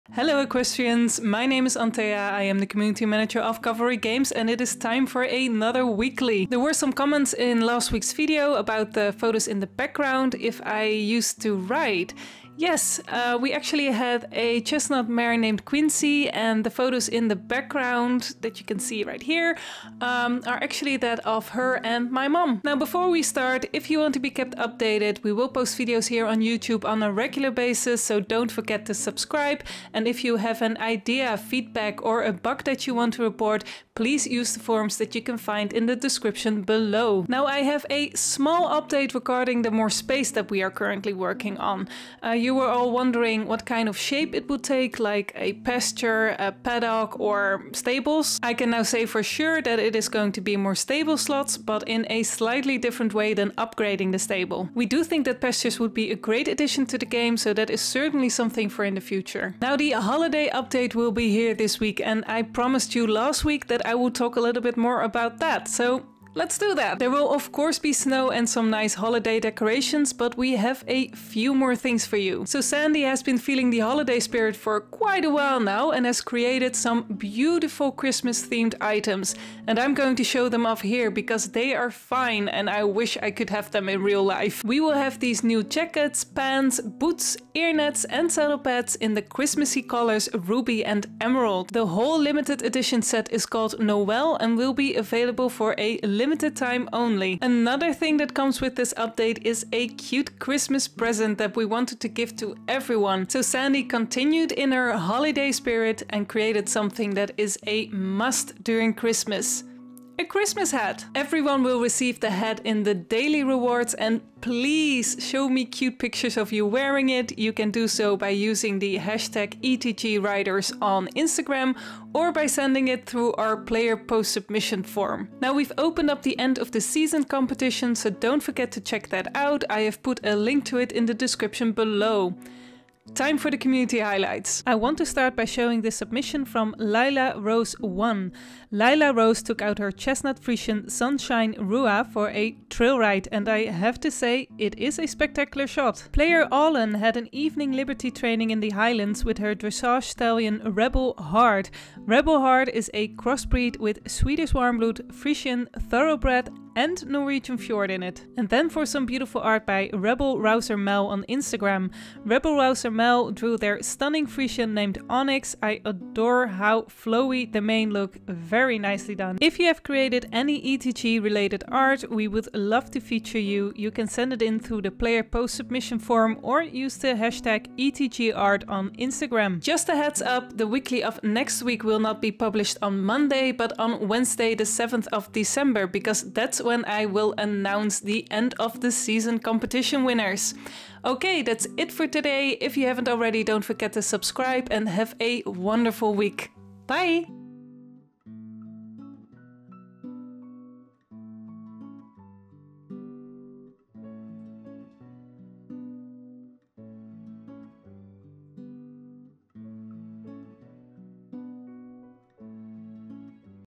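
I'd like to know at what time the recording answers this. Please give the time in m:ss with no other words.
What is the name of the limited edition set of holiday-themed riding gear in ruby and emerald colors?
1:33.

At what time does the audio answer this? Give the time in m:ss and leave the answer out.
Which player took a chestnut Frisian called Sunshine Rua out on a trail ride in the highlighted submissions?
2:16.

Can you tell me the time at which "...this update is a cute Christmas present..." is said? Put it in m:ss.
1:38.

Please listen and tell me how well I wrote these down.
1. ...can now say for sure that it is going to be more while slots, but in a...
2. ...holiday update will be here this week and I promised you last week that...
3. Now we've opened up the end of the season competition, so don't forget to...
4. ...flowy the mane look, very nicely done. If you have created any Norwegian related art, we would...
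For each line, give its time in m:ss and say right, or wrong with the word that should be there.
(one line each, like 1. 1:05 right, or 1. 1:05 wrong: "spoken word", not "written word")
1. 0:48 wrong: "stable", not "while"
2. 0:59 right
3. 2:05 right
4. 2:46 wrong: "ETG", not "Norwegian".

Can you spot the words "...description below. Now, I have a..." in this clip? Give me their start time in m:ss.
0:35.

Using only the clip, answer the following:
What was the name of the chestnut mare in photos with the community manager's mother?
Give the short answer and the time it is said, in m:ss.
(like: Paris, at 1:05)
Quincy, at 0:15.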